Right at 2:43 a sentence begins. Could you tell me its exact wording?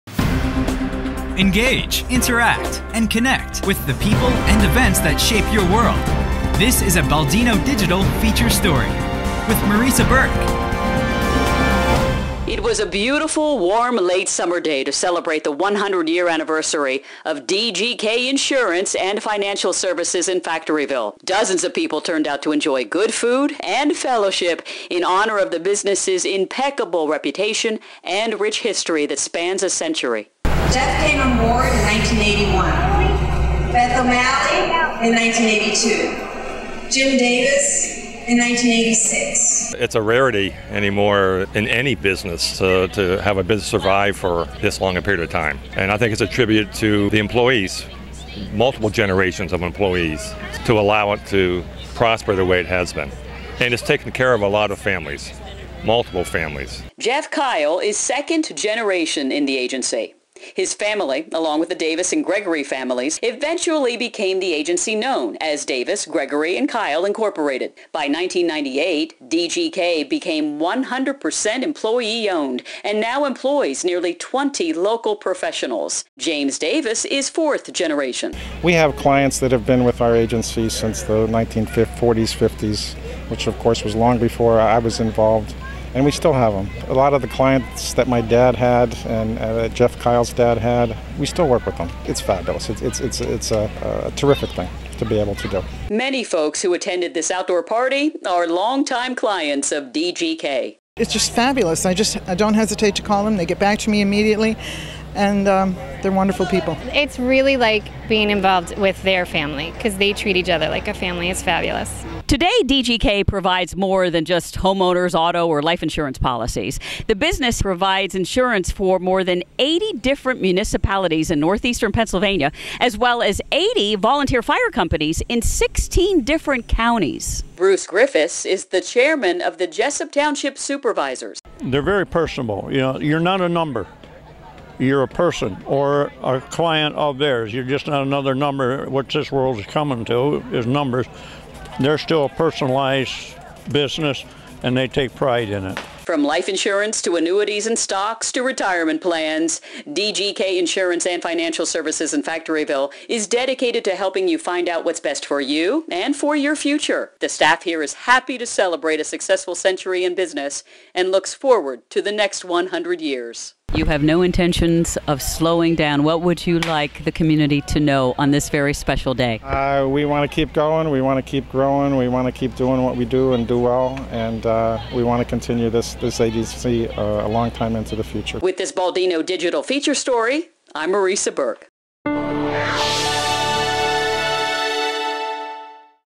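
You have no intentions of slowing down.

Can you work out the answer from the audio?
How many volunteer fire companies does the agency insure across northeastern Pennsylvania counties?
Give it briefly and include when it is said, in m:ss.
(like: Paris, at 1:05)
80, at 2:03.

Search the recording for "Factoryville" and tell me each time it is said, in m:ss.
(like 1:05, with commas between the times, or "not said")
0:20, 2:32.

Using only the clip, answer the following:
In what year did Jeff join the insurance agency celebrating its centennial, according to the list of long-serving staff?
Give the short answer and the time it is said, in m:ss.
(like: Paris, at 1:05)
1981, at 0:31.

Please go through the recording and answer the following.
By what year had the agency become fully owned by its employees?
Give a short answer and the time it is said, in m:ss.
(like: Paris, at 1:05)
1998, at 1:08.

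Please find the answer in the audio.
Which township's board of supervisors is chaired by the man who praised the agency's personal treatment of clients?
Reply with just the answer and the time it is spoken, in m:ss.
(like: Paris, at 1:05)
Jessup Township, at 2:09.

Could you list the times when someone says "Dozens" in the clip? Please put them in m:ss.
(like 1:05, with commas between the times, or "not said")
0:21.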